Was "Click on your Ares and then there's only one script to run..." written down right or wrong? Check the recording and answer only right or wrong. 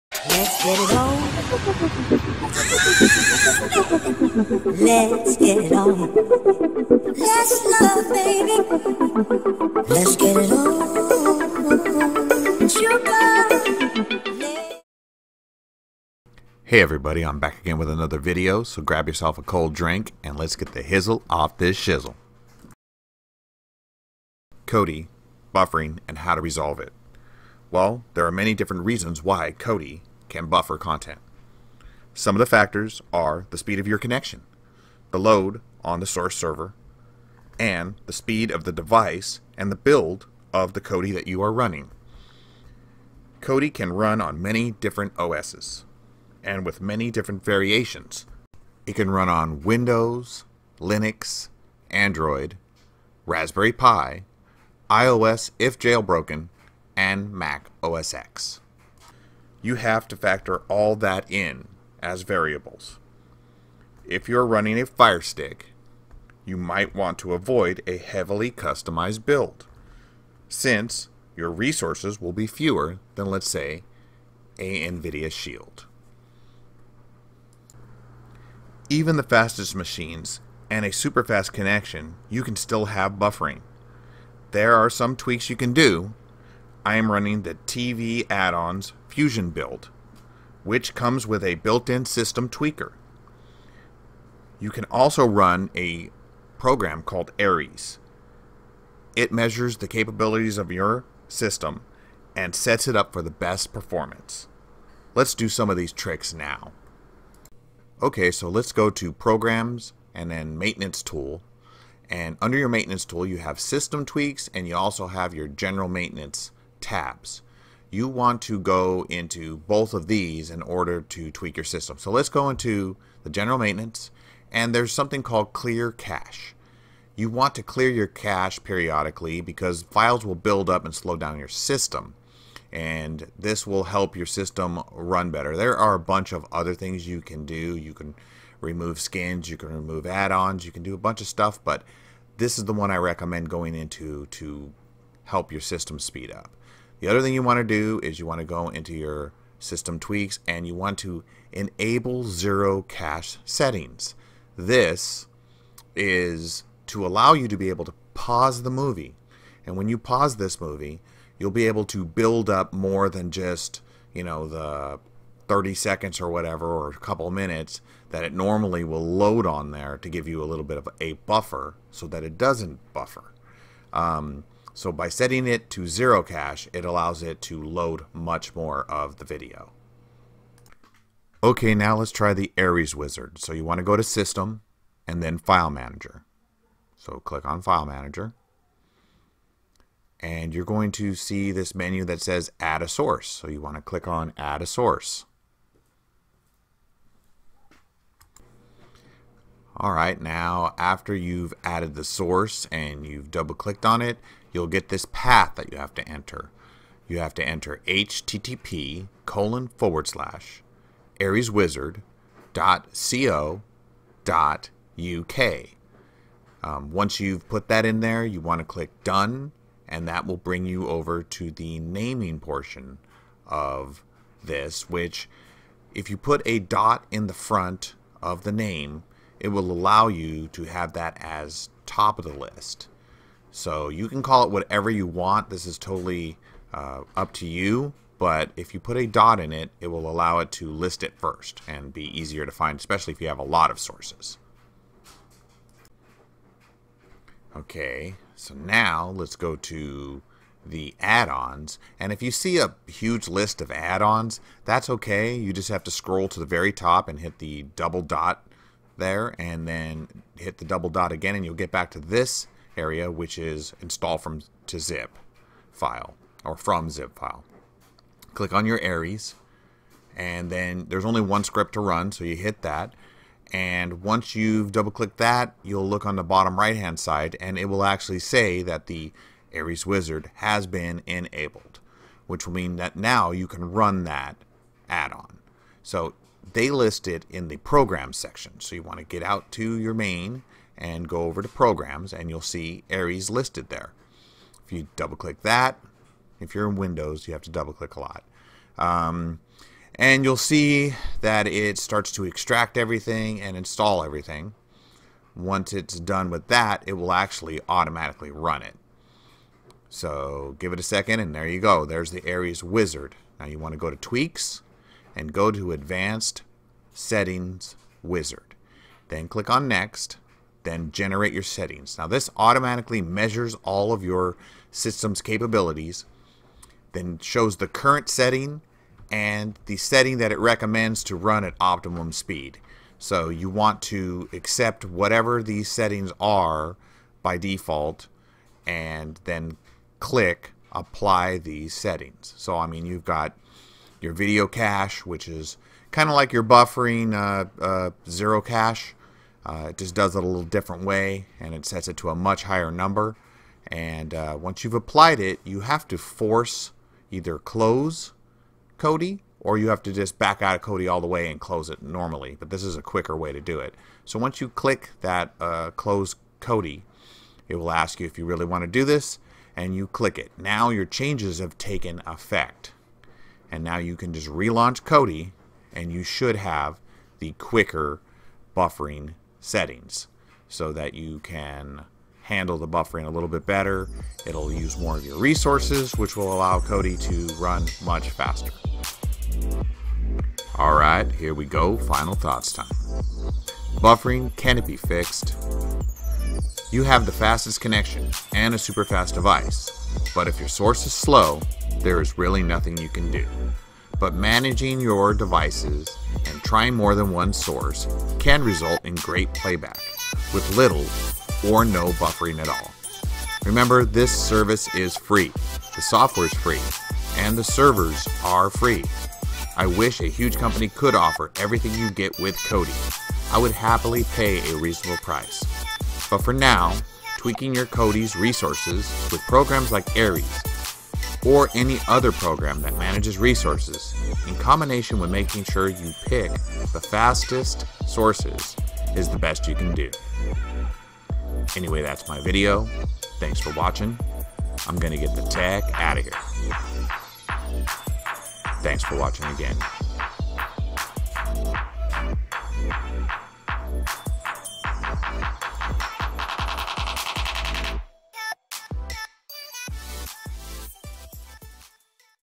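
right.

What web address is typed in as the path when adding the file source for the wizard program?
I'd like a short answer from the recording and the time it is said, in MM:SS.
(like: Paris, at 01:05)
areswizard.co.uk, at 03:31.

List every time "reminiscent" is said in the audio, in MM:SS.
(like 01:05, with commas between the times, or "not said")
not said.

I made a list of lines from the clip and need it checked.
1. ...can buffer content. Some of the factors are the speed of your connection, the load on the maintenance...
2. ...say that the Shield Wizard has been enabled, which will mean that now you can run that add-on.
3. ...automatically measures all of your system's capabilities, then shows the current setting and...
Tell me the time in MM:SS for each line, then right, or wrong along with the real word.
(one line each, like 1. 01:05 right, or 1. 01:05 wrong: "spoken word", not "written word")
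1. 00:30 wrong: "source", not "maintenance"
2. 04:38 wrong: "Ares", not "Shield"
3. 05:22 right.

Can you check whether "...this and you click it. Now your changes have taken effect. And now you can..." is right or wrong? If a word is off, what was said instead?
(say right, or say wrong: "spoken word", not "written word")
right.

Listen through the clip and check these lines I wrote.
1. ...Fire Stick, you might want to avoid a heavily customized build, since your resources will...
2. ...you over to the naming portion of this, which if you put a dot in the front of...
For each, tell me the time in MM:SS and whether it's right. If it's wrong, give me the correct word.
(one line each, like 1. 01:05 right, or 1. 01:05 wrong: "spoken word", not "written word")
1. 01:04 right
2. 03:40 right.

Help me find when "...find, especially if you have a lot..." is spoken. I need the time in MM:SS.
04:02.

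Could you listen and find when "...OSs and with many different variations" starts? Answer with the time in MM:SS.
00:45.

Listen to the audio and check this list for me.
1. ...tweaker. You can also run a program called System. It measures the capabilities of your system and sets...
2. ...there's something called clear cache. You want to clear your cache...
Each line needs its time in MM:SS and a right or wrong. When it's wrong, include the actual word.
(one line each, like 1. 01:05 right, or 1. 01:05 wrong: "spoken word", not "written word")
1. 01:32 wrong: "Ares", not "System"
2. 02:04 right.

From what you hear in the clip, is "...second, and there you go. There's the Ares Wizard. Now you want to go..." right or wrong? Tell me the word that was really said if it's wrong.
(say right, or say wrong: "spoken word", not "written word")
right.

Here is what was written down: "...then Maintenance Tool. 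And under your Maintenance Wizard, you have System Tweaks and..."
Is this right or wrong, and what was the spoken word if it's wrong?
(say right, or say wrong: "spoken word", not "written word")
wrong: "Tool", not "Wizard".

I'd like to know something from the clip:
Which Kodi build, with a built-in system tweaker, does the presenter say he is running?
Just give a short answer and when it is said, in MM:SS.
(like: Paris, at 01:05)
Fusion, at 01:29.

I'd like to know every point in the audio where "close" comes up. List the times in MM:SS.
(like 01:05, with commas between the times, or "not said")
05:57, 06:01, 06:05.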